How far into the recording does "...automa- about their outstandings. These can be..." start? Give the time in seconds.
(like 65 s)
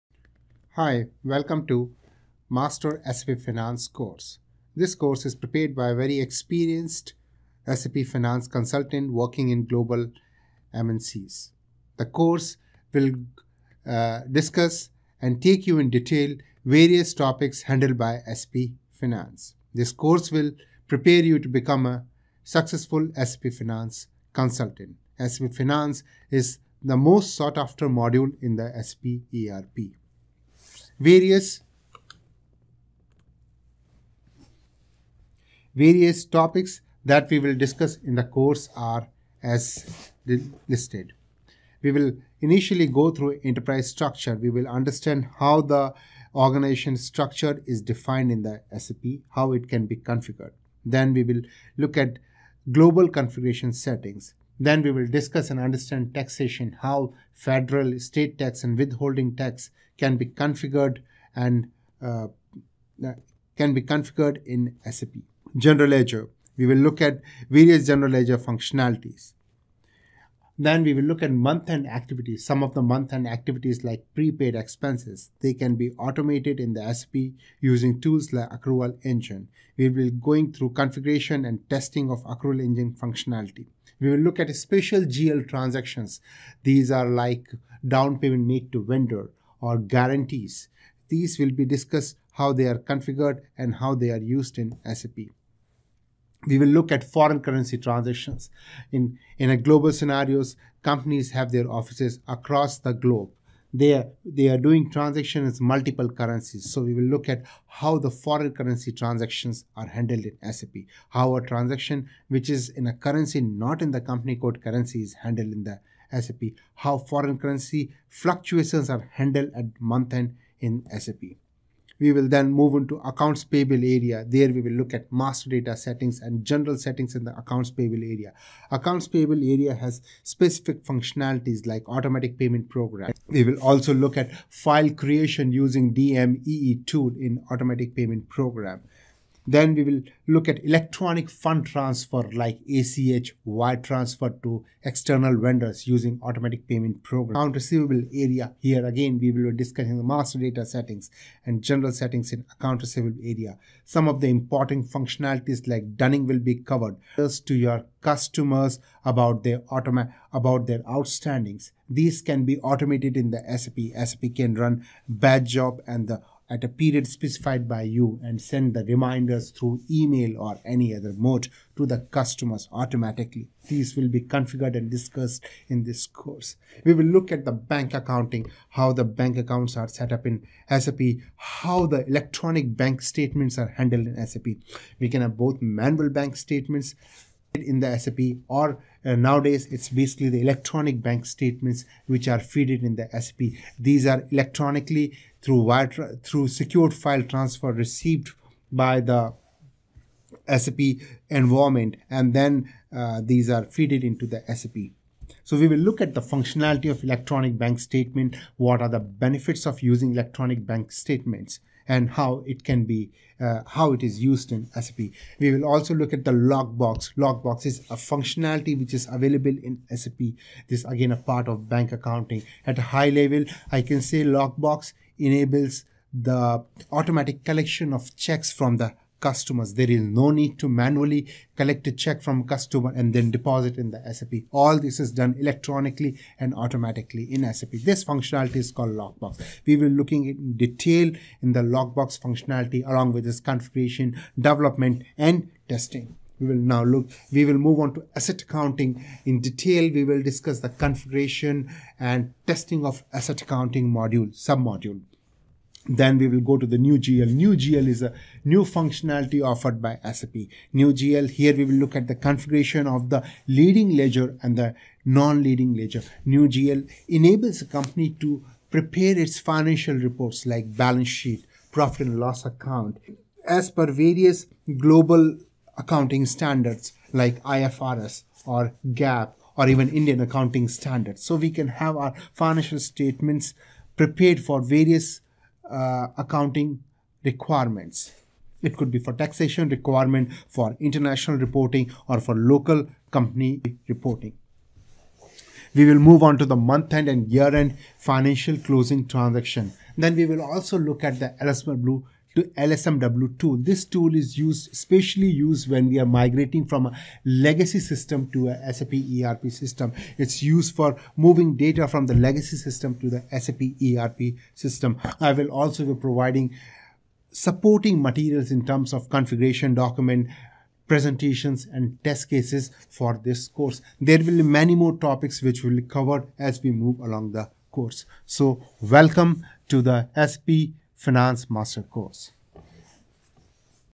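159 s.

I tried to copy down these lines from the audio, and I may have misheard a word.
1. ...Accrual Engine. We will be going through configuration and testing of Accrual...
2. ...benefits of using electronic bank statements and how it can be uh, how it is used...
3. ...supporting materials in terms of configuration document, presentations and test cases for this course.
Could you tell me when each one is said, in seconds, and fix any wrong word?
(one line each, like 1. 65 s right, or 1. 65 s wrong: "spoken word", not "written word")
1. 78 s right
2. 208 s right
3. 317 s right.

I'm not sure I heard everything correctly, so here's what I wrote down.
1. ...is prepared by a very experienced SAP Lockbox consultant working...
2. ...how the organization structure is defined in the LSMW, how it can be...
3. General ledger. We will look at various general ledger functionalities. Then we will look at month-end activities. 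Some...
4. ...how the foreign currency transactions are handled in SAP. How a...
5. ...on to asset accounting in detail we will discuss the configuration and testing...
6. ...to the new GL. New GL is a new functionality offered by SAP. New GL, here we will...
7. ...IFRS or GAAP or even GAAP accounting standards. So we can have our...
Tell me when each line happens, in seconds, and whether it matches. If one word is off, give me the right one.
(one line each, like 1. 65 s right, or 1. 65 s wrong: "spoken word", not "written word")
1. 5 s wrong: "Finance", not "Lockbox"
2. 45 s wrong: "SAP", not "LSMW"
3. 65 s right
4. 107 s right
5. 247 s right
6. 256 s right
7. 277 s wrong: "Indian", not "GAAP".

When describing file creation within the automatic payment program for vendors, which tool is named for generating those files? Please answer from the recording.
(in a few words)
DMEE.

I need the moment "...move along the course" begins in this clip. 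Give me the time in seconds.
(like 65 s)
326 s.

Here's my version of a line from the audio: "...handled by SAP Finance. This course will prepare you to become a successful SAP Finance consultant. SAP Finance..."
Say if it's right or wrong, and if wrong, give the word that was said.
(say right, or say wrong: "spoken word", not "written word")
right.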